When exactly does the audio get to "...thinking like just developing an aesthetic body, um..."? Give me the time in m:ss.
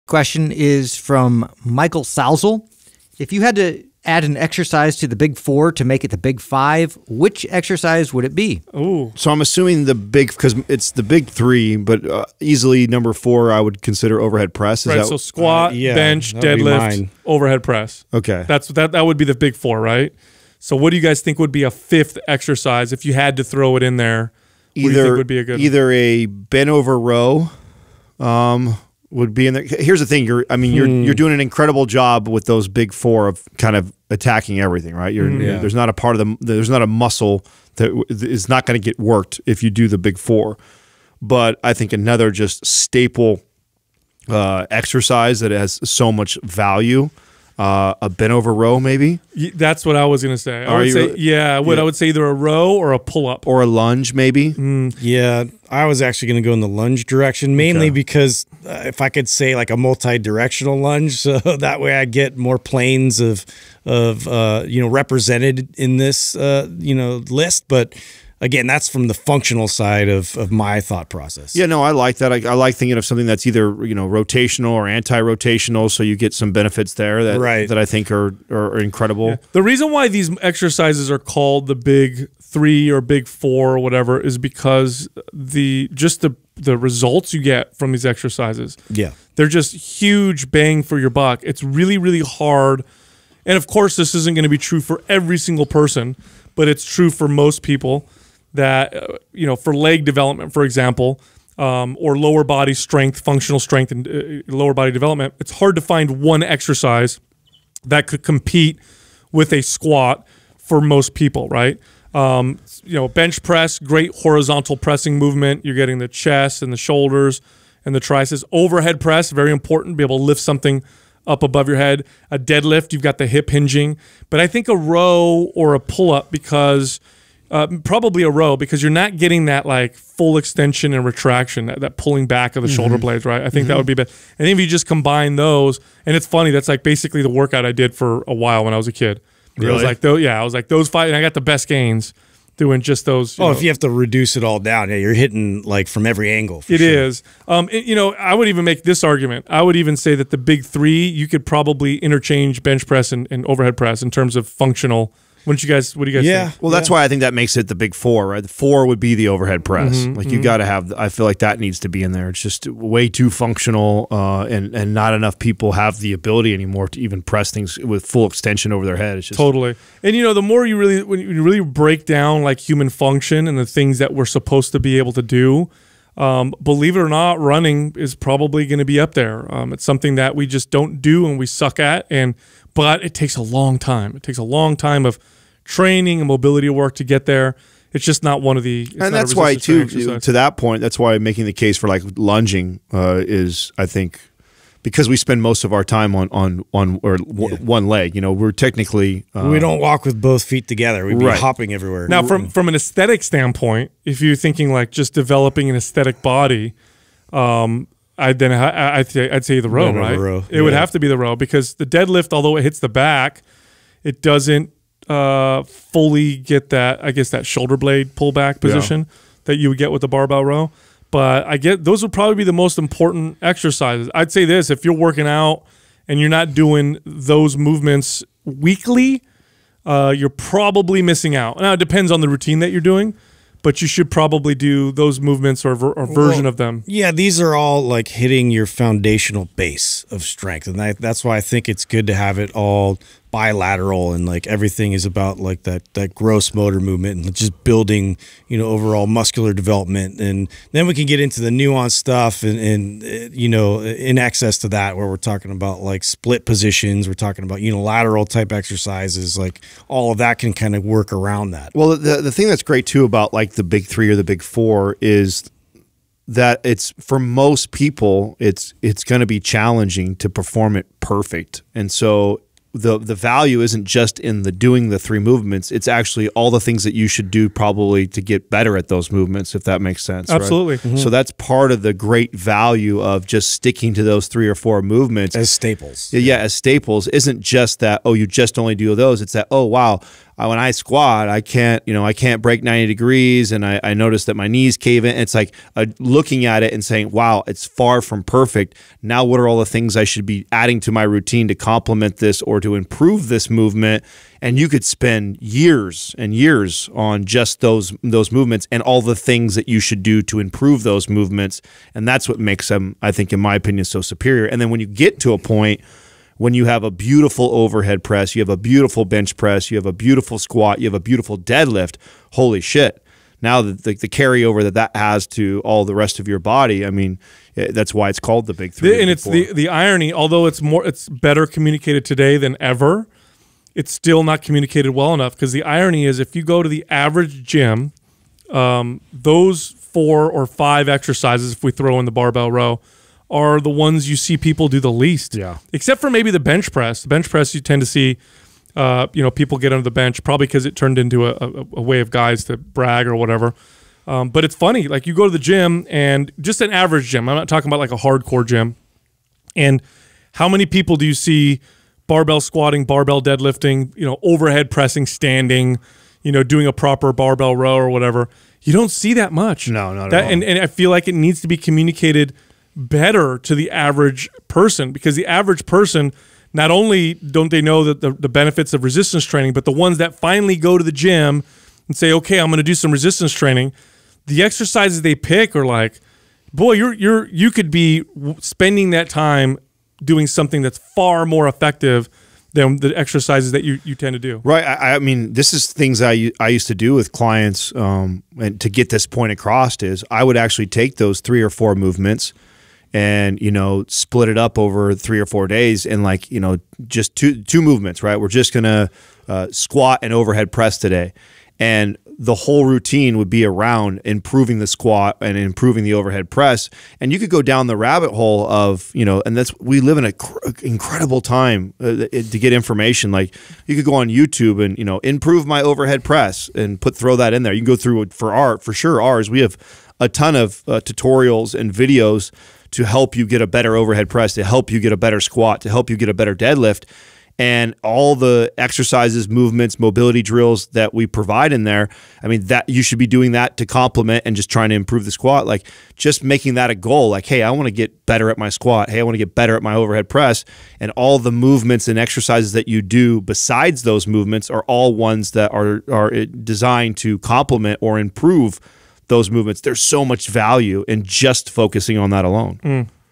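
3:24.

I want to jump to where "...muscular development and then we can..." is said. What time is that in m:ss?
4:09.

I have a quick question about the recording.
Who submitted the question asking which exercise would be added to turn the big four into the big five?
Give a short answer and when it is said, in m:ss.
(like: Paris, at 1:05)
Michael Sousel, at 0:01.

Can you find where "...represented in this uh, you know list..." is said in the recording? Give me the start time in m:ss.
1:04.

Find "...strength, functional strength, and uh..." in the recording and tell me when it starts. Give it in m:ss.
1:42.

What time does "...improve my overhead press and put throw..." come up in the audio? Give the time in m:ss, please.
7:04.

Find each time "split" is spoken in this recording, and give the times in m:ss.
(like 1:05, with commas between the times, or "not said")
4:16, 6:43.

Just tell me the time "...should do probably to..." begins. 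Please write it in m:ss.
4:37.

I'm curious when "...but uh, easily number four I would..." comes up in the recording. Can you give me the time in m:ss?
0:11.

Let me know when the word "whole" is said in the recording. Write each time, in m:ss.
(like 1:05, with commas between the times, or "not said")
6:52.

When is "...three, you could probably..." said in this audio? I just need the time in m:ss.
2:30.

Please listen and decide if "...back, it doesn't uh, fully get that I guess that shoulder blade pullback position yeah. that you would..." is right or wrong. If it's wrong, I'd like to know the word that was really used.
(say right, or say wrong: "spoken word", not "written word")
right.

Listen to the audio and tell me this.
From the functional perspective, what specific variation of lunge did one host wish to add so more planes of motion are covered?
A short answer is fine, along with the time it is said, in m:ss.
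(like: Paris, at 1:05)
Multi-directional lunge, at 0:59.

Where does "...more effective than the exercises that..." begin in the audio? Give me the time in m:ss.
6:31.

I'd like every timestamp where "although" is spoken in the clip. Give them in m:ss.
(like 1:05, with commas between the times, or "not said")
3:32, 5:30.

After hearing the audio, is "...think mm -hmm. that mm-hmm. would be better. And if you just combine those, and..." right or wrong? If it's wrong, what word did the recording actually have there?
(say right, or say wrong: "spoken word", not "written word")
right.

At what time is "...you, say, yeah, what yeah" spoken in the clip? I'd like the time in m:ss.
0:50.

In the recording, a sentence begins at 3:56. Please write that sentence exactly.
Yeah, these are all like hitting your foundational base of strength.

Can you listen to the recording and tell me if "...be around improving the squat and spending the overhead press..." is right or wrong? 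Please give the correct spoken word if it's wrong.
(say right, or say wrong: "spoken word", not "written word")
wrong: "improving", not "spending".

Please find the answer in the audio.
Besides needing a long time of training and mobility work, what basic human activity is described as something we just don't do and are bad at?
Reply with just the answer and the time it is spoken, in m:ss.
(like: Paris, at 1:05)
Running, at 2:57.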